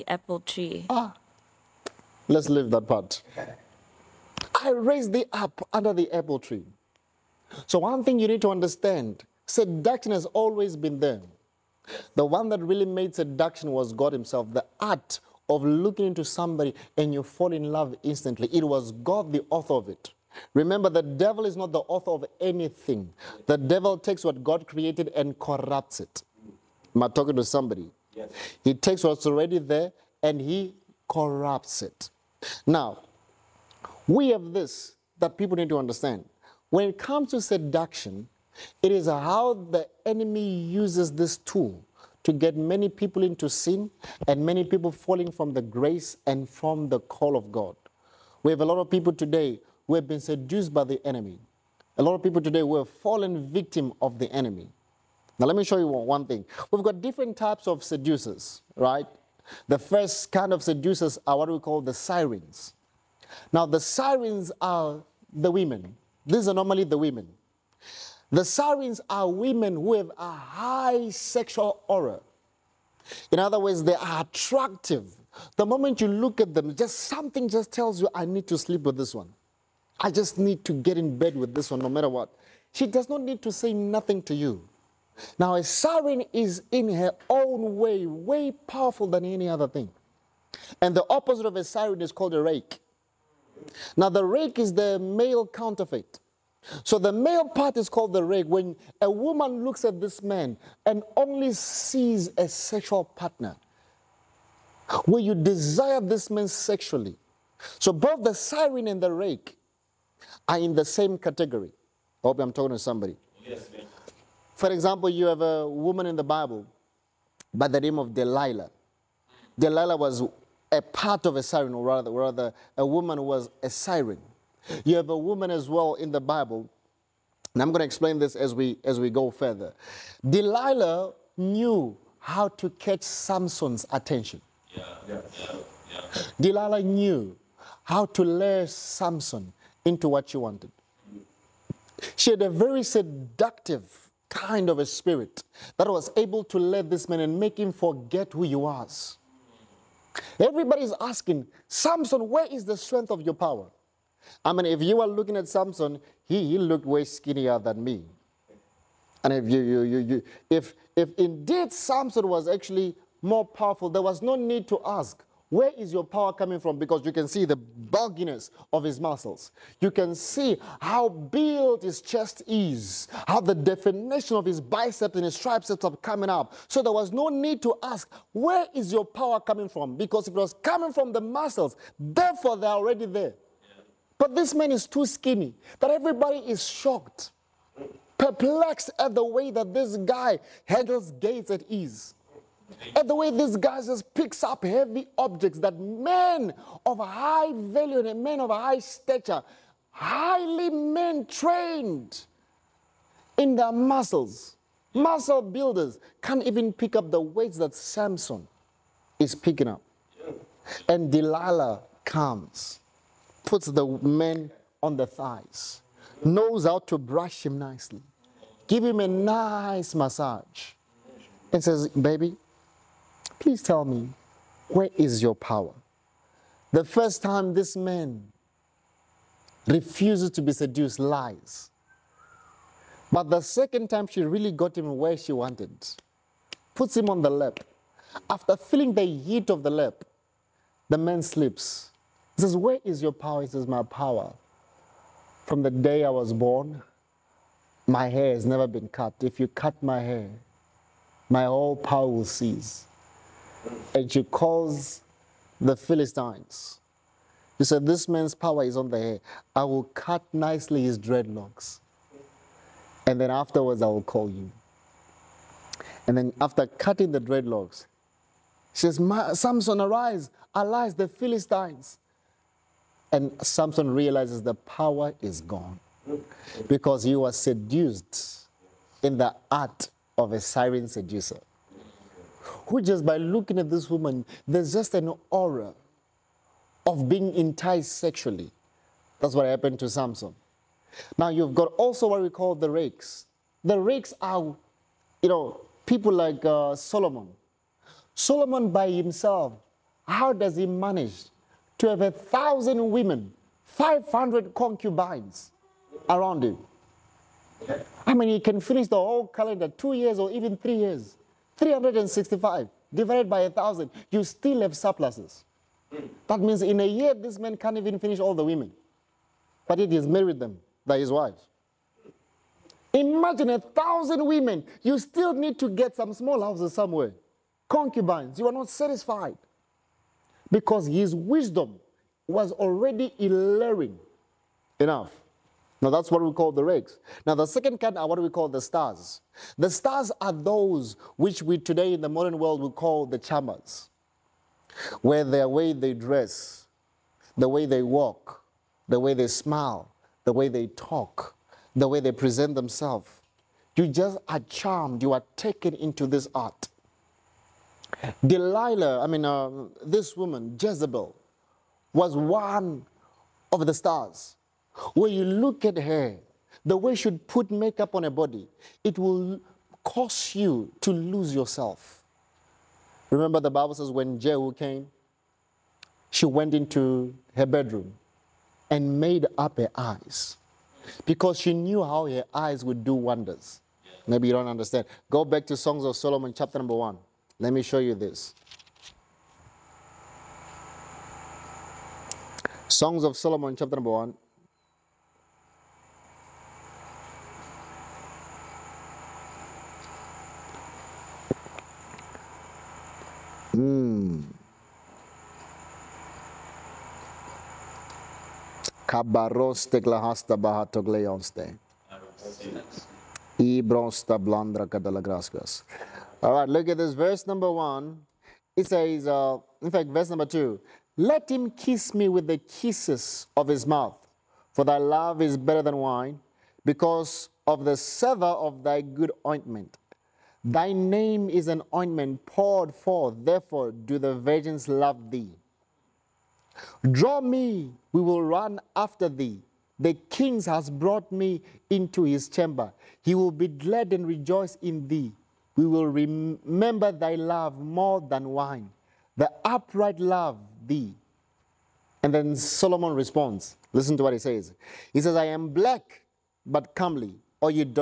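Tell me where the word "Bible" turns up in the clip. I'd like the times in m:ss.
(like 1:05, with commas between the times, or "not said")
1:56, 2:06, 6:13.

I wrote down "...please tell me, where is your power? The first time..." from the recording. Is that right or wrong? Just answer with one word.
right.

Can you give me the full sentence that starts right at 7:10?
Thy name is an ointment poured forth, therefore do the virgins love thee.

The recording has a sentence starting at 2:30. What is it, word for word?
Everybody's asking, Samson, where is the strength of your power?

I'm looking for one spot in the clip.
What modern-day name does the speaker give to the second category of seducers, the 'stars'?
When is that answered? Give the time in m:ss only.
5:43.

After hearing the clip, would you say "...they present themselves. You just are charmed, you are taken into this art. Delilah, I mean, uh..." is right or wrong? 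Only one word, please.
right.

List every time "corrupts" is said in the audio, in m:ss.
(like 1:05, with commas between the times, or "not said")
0:25, 0:31.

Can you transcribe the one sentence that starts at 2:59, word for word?
Because it was coming from the muscles, therefore they're already there.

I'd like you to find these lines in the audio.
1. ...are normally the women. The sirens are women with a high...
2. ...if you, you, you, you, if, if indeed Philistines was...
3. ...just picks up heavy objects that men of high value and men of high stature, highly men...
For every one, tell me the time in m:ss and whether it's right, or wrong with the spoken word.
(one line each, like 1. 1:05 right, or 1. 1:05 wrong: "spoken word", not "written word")
1. 1:06 right
2. 2:39 wrong: "Samson", not "Philistines"
3. 3:13 right.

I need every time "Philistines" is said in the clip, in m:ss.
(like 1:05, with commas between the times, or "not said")
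4:15, 4:31.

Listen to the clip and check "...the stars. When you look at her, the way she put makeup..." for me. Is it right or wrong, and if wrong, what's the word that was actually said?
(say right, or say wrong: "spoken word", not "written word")
right.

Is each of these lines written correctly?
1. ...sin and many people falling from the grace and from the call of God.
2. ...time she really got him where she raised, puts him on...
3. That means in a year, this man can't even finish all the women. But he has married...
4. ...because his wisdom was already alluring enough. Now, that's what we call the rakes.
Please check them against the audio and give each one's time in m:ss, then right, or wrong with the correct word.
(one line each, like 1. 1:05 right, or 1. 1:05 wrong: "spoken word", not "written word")
1. 0:43 right
2. 3:53 wrong: "wanted", not "raised"
3. 5:16 right
4. 5:30 right.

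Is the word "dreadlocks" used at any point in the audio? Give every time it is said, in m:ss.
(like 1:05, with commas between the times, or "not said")
4:20, 4:27.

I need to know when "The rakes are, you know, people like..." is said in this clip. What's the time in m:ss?
4:53.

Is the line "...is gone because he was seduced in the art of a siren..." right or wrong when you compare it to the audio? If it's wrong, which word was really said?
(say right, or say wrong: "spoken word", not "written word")
right.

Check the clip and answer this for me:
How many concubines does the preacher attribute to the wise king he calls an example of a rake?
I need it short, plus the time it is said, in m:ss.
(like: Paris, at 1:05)
500, at 5:03.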